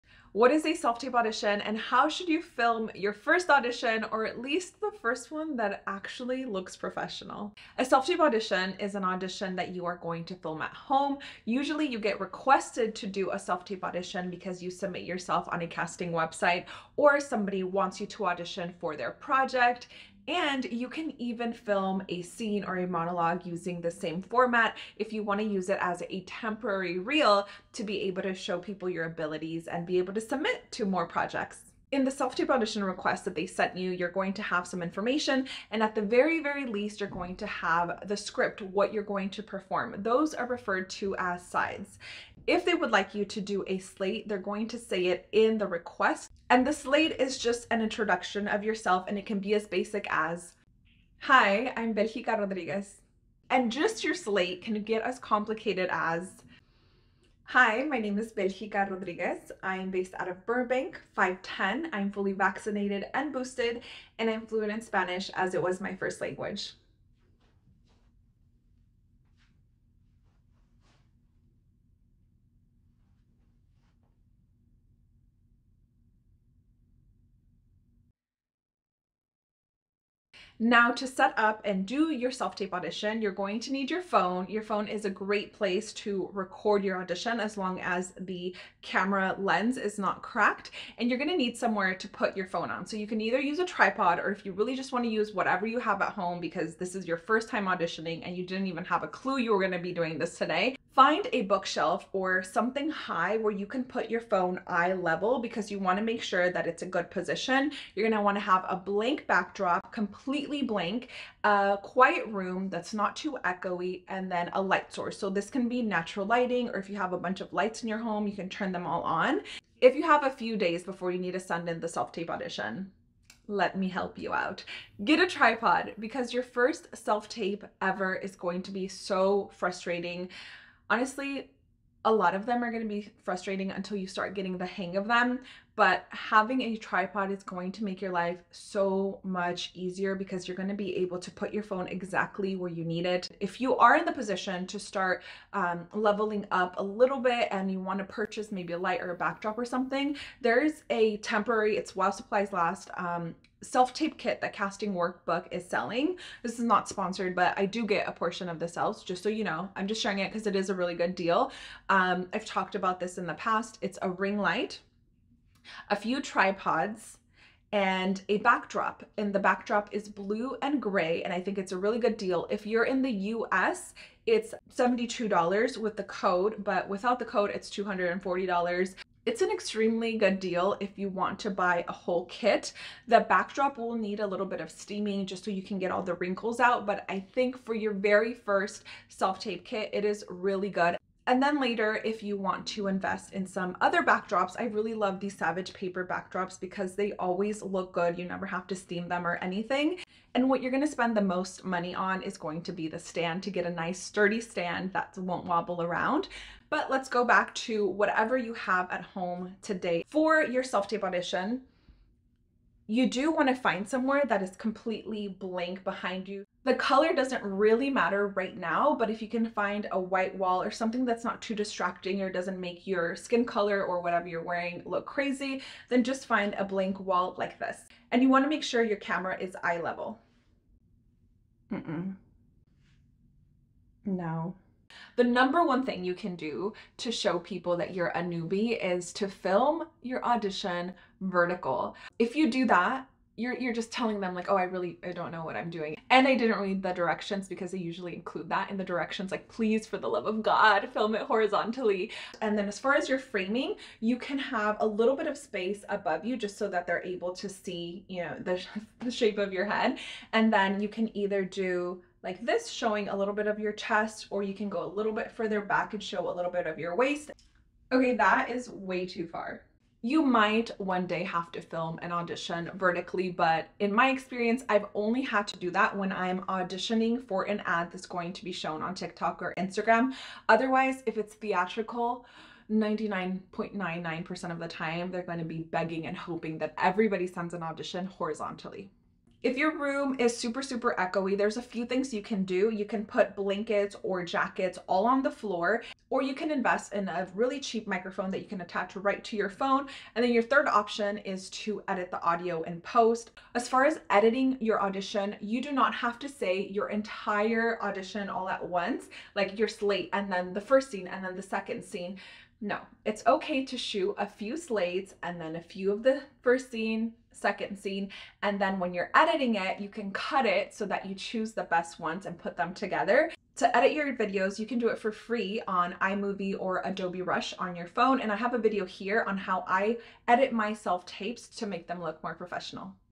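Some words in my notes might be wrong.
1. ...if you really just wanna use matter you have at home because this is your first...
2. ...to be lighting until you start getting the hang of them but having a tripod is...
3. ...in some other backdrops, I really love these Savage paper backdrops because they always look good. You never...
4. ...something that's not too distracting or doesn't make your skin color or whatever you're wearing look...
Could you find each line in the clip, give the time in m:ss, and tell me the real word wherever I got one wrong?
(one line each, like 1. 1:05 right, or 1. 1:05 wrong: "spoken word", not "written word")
1. 1:34 wrong: "whatever", not "matter"
2. 2:12 wrong: "frustrating", not "lighting"
3. 3:13 right
4. 3:40 right.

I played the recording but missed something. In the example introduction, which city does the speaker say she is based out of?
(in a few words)
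Burbank.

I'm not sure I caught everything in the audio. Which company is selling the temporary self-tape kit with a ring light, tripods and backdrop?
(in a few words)
Casting Workbook.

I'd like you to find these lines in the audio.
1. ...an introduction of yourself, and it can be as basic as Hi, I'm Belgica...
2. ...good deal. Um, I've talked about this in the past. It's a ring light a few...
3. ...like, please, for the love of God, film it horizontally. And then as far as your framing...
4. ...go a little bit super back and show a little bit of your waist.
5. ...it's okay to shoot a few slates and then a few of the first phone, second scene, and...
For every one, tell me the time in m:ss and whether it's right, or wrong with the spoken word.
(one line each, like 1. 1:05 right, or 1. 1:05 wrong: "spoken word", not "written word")
1. 0:47 right
2. 2:40 right
3. 4:09 right
4. 4:24 wrong: "further", not "super"
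5. 5:13 wrong: "scene", not "phone".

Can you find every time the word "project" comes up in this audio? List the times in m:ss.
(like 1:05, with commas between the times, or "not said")
0:19, 0:31.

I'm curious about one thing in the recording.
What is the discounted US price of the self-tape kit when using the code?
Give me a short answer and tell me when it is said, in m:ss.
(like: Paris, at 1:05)
$72, at 2:54.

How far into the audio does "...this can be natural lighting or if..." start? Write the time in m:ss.
1:55.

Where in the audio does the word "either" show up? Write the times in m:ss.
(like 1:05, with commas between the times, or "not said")
1:33, 4:21.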